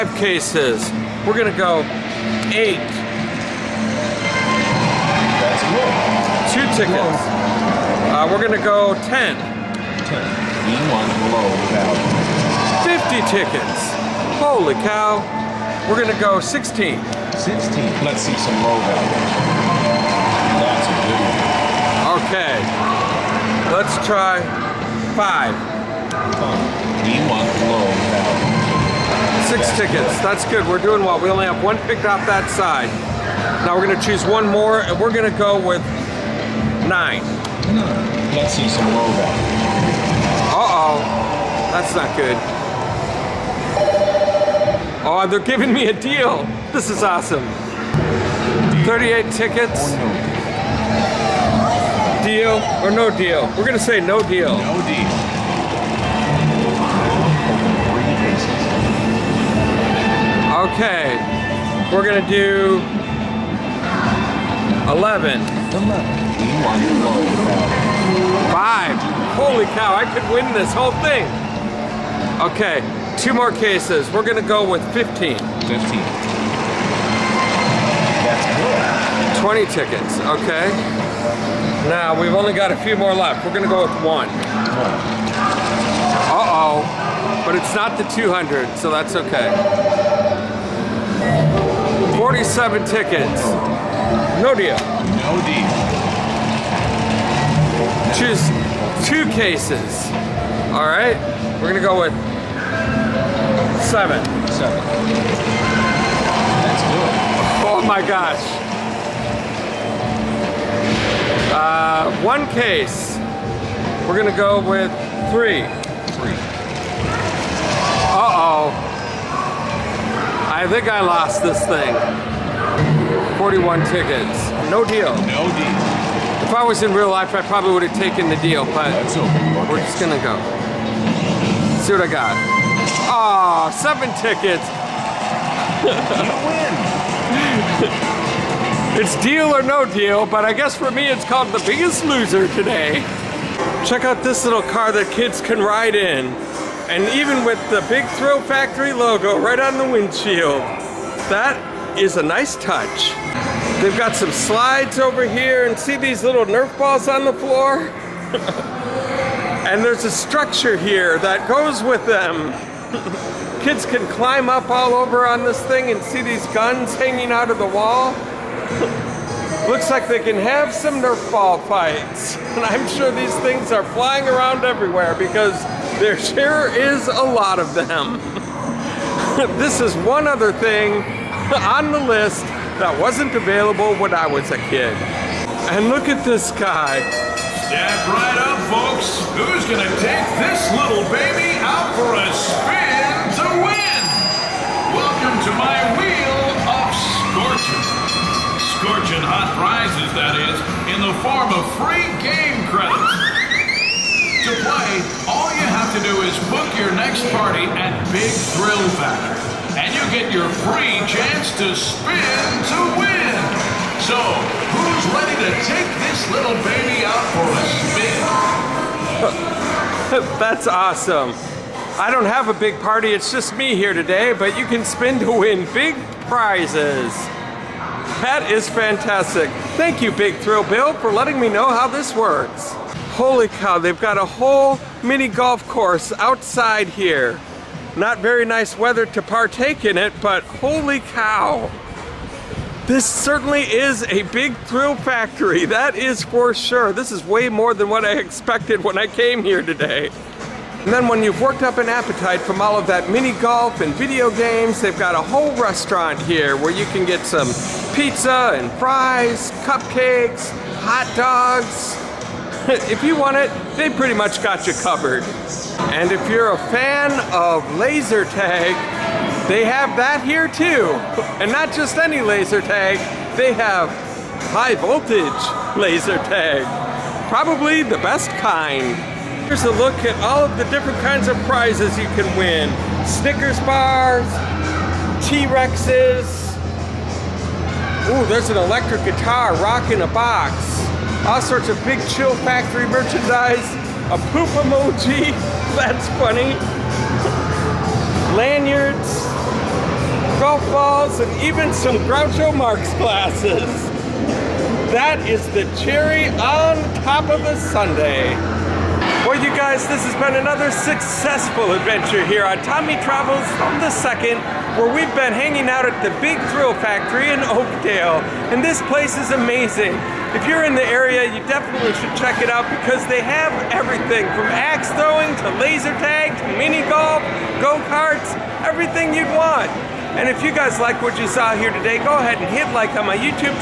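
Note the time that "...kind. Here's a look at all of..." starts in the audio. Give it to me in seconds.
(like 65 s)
278 s.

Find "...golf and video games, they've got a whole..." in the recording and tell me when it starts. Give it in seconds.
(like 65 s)
253 s.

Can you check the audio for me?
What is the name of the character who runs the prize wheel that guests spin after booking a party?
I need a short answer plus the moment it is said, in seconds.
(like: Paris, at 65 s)
Big Thrill Bill, at 230 s.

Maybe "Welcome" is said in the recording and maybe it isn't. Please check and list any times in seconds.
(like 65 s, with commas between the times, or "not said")
194 s.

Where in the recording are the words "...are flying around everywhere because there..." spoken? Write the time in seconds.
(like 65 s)
173 s.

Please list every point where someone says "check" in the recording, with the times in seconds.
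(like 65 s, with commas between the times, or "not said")
143 s, 322 s.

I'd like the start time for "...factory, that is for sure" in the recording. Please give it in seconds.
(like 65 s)
244 s.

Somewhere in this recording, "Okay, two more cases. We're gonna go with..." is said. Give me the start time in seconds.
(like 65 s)
72 s.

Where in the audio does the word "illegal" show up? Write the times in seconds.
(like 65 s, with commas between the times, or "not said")
not said.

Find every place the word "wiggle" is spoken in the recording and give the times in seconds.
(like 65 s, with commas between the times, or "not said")
not said.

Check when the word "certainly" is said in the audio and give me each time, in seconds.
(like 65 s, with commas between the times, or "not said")
243 s.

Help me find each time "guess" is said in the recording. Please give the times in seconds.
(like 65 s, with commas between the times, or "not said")
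140 s.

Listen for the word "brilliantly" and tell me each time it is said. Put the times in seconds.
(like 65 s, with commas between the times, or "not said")
not said.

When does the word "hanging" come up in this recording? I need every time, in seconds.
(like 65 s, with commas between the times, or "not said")
166 s, 315 s.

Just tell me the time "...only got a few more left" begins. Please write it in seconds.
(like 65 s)
82 s.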